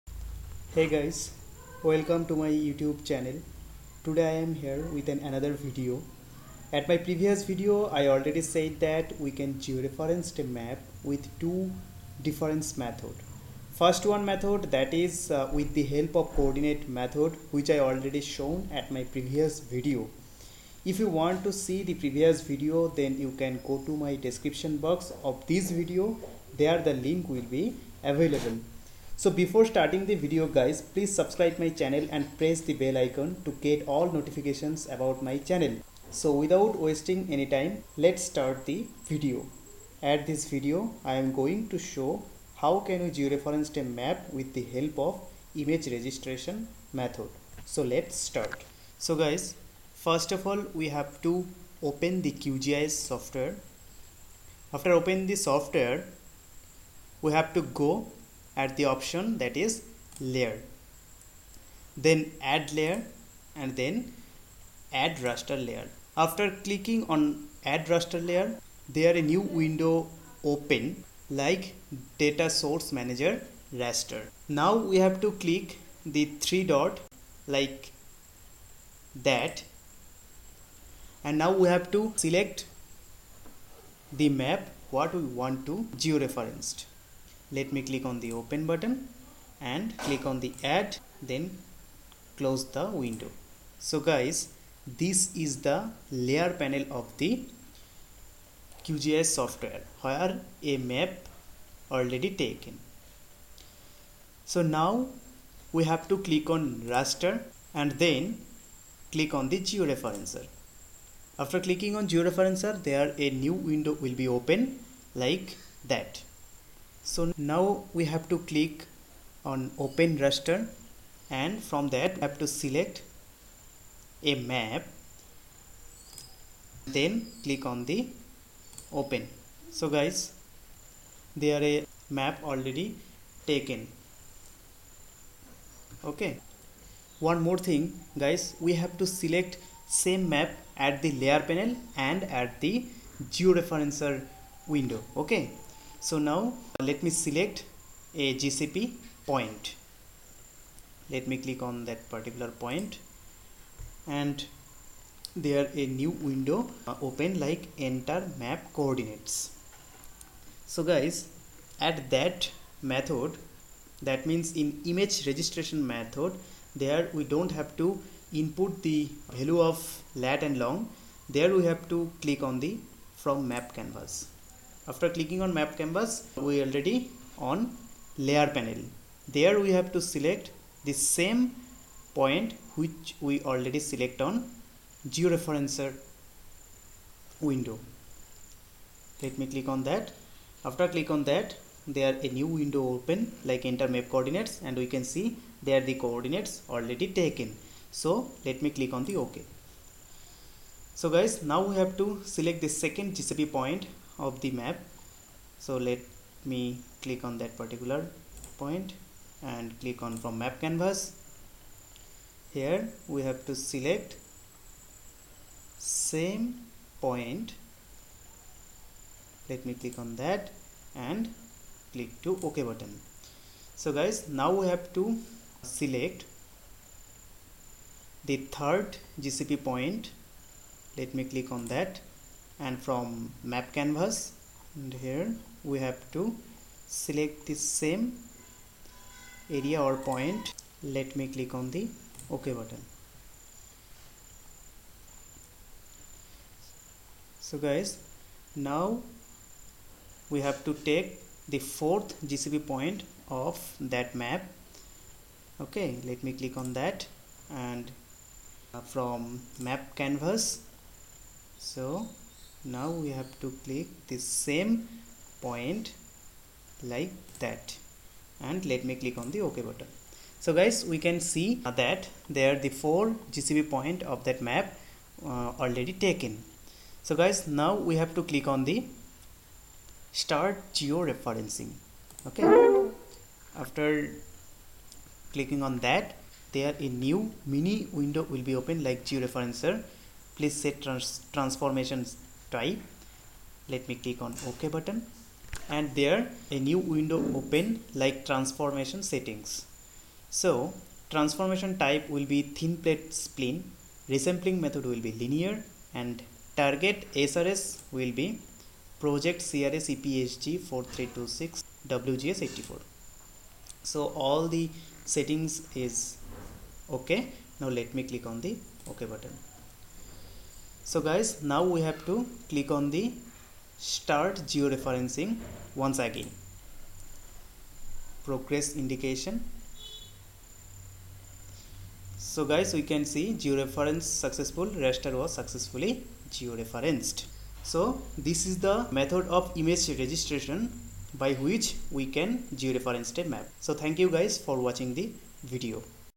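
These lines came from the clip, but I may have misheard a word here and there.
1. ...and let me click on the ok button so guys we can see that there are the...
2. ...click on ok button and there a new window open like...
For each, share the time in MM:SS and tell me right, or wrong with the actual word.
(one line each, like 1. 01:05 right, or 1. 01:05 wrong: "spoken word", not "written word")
1. 04:28 right
2. 04:54 right.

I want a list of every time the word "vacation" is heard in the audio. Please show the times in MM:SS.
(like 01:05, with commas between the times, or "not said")
not said.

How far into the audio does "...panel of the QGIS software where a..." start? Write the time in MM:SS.
01:36.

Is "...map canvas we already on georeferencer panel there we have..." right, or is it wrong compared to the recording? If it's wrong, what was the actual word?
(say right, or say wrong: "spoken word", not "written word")
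wrong: "layer", not "georeferencer".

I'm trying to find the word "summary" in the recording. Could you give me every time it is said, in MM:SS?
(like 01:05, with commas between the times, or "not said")
not said.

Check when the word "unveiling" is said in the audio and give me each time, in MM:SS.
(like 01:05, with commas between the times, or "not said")
not said.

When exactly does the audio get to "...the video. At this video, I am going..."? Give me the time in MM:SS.
00:38.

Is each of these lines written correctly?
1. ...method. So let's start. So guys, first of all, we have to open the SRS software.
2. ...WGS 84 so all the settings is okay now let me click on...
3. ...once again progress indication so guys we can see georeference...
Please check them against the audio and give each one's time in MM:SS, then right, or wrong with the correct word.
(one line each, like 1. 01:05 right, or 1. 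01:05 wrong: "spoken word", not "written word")
1. 00:46 wrong: "QGIS", not "SRS"
2. 05:11 right
3. 05:25 right.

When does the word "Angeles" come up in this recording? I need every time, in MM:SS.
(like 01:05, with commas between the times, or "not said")
not said.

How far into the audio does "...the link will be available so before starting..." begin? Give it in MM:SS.
00:26.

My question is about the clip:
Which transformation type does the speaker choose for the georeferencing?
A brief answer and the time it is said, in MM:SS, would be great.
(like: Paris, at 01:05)
Thin plate spline, at 05:02.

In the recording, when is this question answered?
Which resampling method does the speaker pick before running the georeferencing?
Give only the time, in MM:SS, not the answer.
05:05.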